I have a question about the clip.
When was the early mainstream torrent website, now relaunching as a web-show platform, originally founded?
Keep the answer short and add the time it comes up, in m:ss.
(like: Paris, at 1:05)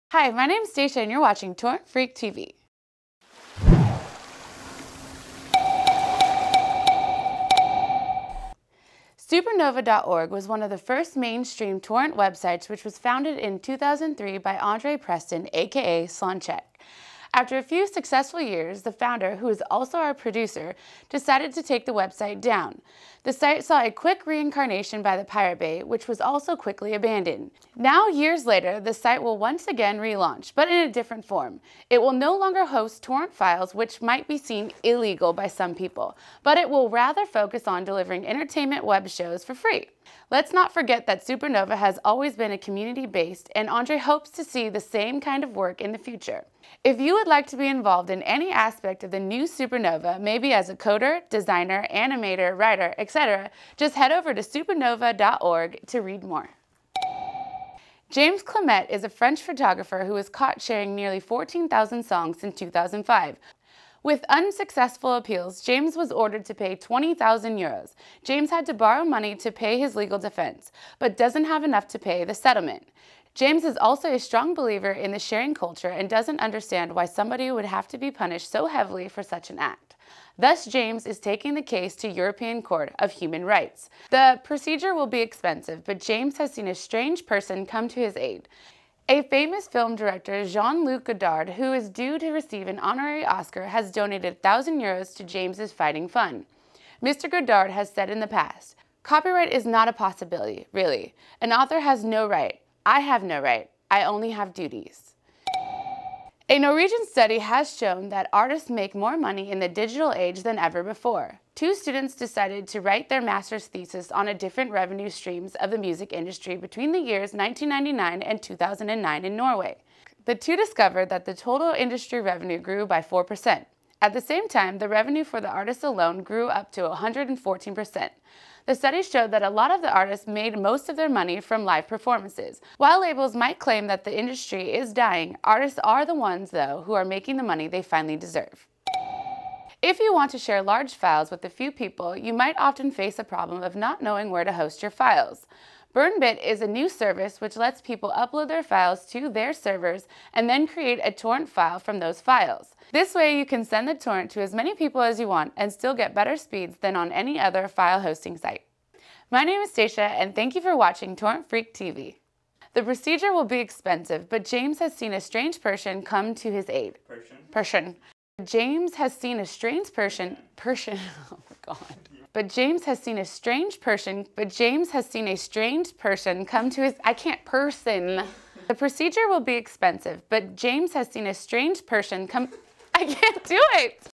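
2003, at 0:13.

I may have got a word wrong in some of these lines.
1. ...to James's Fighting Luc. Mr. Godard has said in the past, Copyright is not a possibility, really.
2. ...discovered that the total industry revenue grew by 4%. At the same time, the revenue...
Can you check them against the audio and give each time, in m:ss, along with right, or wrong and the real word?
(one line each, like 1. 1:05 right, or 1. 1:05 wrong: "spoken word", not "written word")
1. 1:35 wrong: "Fund", not "Luc"
2. 2:00 right.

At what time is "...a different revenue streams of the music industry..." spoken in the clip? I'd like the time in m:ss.
1:54.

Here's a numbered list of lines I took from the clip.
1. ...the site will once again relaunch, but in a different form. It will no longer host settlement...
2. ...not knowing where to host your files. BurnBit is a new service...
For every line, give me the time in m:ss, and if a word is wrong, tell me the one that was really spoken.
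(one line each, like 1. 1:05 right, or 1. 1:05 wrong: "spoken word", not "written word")
1. 0:28 wrong: "torrent", not "settlement"
2. 2:23 right.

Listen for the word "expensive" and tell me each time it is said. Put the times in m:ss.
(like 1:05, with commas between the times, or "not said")
1:25, 2:43, 2:59.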